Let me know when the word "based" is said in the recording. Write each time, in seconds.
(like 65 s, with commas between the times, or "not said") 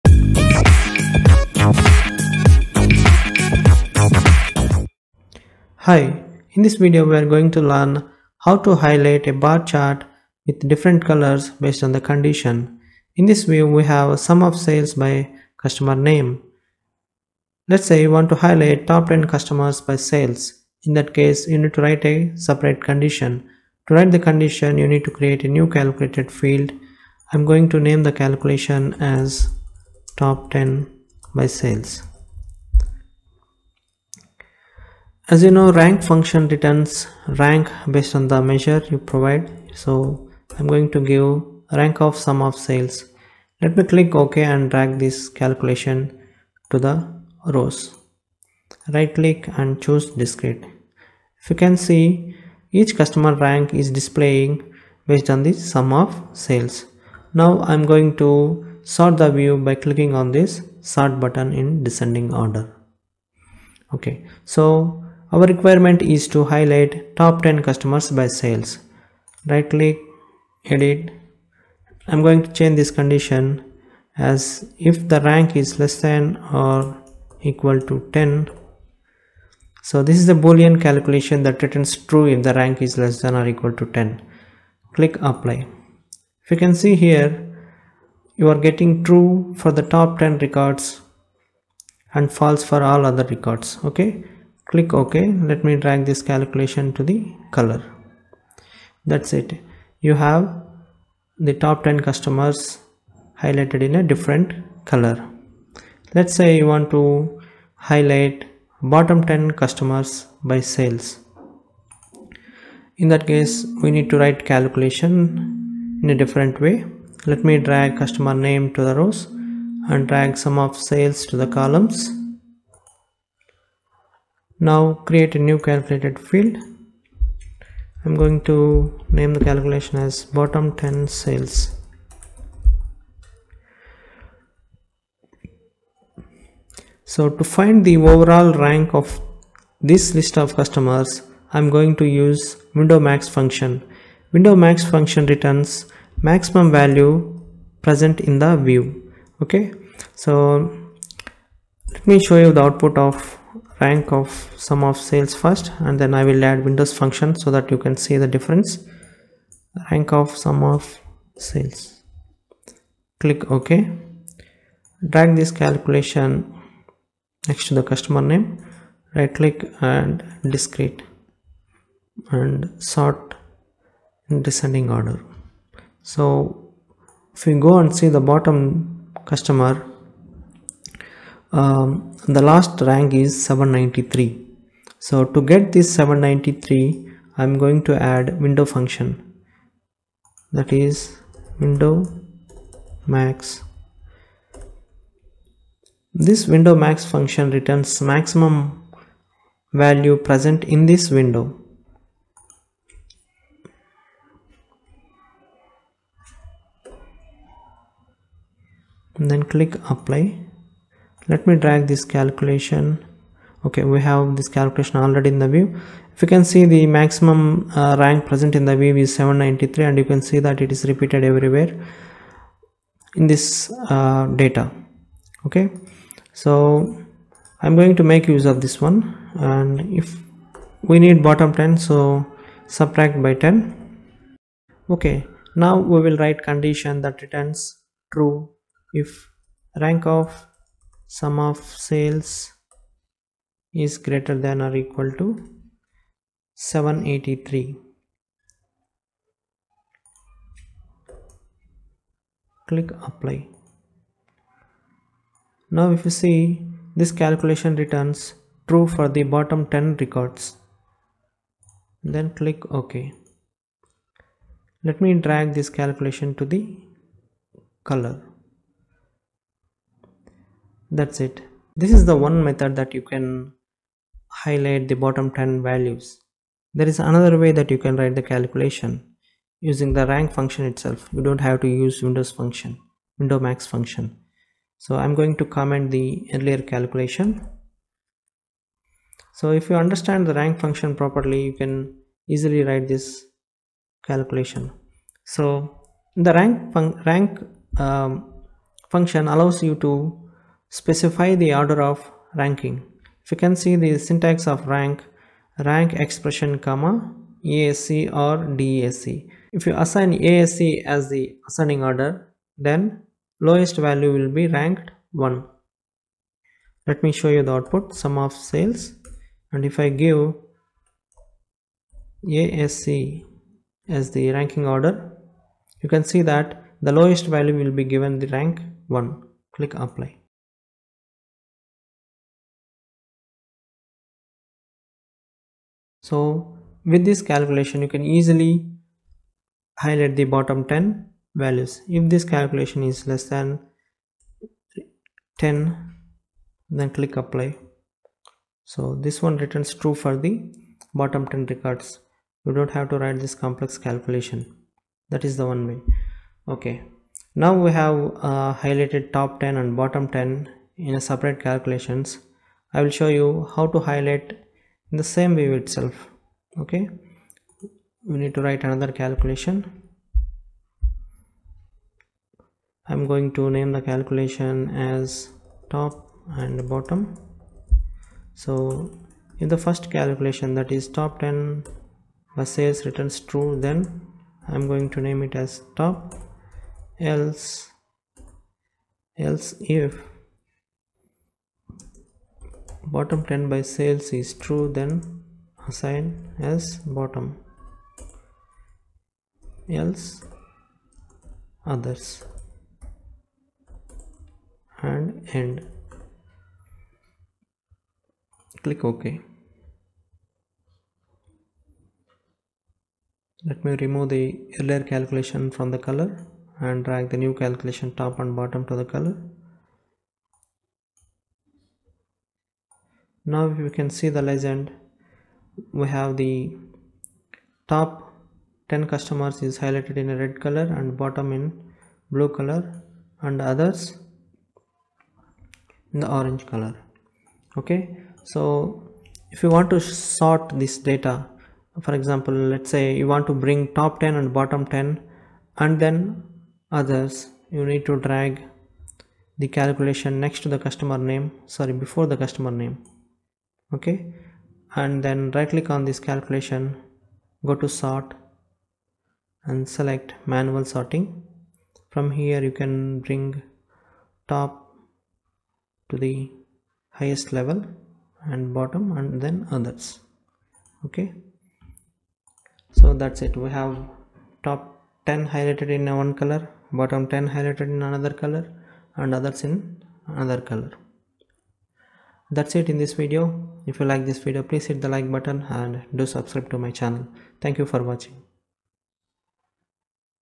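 11 s, 37 s, 55 s.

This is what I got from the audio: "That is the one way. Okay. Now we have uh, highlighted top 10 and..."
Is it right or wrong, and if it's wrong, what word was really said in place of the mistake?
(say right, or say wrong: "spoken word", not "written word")
right.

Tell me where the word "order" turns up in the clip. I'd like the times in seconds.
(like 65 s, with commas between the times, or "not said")
62 s, 174 s, 301 s, 311 s, 324 s.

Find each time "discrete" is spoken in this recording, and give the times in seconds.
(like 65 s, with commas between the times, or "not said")
50 s, 170 s.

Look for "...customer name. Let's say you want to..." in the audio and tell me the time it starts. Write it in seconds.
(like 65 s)
15 s.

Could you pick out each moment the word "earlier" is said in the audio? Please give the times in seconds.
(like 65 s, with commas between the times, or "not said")
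286 s, 414 s.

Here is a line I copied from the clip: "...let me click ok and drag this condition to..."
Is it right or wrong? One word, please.
wrong.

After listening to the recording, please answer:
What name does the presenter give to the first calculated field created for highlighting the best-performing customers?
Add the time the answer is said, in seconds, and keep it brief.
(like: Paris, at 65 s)
top 10 by sales, at 30 s.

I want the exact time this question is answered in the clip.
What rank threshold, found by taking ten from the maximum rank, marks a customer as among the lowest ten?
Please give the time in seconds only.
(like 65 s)
246 s.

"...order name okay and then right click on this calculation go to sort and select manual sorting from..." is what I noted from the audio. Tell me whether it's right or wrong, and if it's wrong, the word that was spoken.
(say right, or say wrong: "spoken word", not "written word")
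wrong: "customer", not "order".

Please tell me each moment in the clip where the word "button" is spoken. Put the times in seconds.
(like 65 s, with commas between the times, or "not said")
61 s, 485 s.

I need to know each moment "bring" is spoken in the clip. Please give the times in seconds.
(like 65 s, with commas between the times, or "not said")
443 s, 463 s.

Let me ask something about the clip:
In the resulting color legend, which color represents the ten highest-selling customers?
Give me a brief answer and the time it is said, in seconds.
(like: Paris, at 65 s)
red, at 430 s.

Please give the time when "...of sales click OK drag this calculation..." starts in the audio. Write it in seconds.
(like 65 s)
160 s.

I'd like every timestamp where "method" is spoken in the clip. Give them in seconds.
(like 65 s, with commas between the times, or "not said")
272 s.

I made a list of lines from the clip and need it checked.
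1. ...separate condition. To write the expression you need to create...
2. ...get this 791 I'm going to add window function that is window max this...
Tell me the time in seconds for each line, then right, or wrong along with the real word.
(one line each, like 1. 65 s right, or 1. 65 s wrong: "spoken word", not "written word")
1. 22 s wrong: "condition", not "expression"
2. 185 s wrong: "793", not "791".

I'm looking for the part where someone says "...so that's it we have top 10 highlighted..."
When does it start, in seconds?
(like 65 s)
472 s.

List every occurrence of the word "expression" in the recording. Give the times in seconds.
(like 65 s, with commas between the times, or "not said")
305 s.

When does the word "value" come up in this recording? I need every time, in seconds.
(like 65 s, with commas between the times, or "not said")
146 s, 199 s, 275 s, 313 s, 327 s, 341 s.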